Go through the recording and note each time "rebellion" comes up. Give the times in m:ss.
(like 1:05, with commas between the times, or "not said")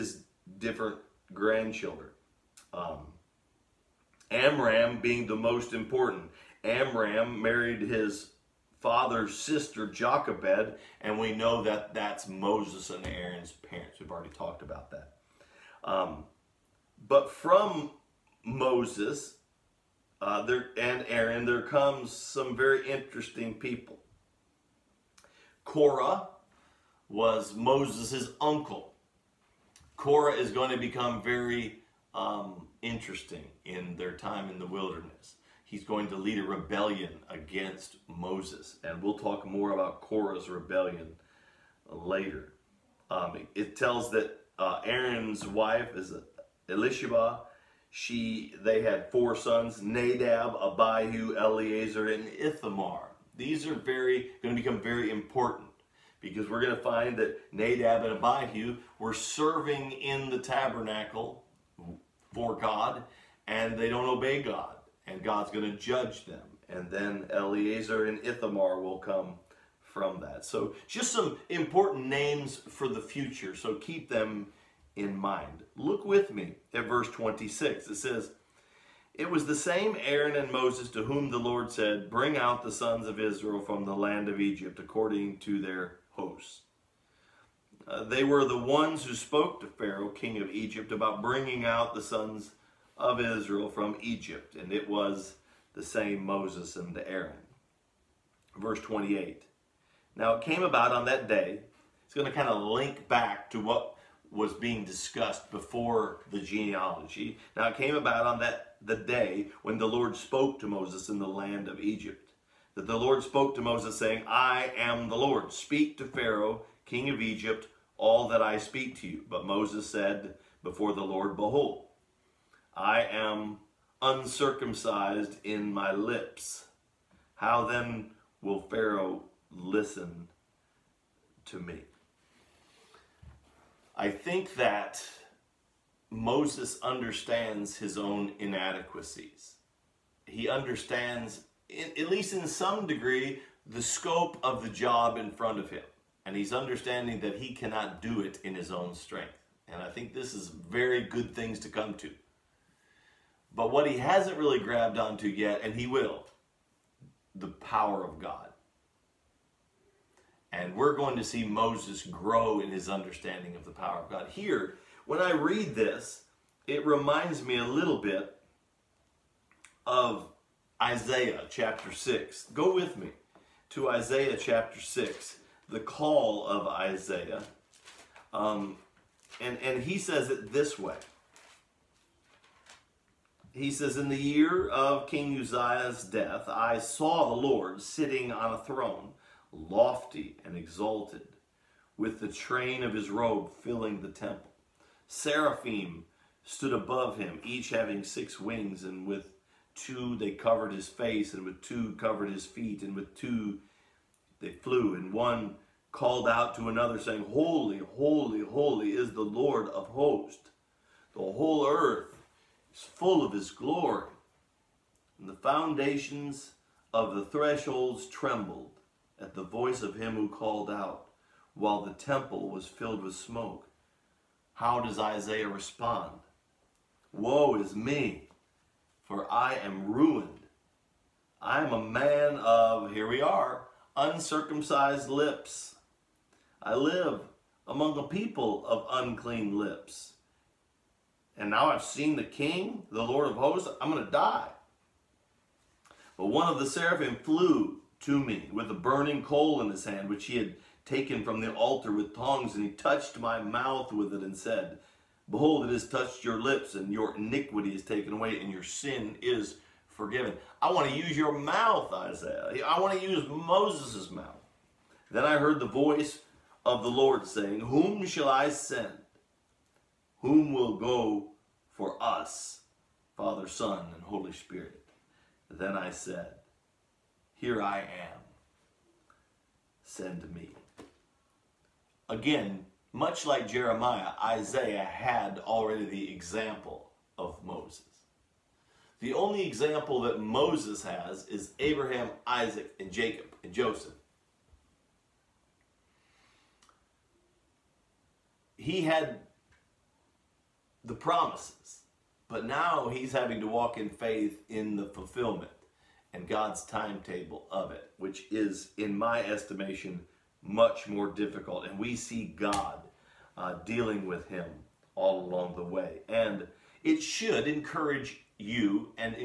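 0:36, 0:40.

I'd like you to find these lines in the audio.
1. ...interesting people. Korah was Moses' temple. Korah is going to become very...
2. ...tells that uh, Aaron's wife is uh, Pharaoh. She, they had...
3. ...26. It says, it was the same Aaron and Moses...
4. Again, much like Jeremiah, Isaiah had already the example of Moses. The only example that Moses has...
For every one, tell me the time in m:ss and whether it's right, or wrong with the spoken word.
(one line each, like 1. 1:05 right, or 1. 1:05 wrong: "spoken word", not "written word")
1. 0:22 wrong: "uncle", not "temple"
2. 0:43 wrong: "Elisheba", not "Pharaoh"
3. 1:17 right
4. 4:42 right.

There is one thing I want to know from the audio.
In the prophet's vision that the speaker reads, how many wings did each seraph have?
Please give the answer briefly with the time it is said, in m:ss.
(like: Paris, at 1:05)
6, at 3:18.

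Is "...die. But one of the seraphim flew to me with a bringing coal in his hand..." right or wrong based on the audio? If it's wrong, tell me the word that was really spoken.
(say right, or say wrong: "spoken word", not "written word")
wrong: "burning", not "bringing".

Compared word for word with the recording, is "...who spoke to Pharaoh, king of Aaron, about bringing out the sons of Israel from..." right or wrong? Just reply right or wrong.
wrong.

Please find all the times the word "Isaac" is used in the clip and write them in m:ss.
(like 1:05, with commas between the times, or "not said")
4:52.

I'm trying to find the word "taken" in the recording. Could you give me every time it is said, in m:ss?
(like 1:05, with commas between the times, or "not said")
4:10, 4:17.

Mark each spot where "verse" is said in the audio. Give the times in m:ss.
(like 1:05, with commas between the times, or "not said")
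1:16, 1:38.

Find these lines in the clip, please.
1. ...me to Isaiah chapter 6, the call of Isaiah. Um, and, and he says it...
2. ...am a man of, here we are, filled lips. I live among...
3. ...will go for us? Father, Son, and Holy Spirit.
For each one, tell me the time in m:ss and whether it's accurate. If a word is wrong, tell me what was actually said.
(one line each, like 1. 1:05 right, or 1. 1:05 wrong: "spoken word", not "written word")
1. 2:52 right
2. 3:51 wrong: "uncircumcised", not "filled"
3. 4:30 right.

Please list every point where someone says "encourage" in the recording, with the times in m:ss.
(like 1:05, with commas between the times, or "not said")
5:17.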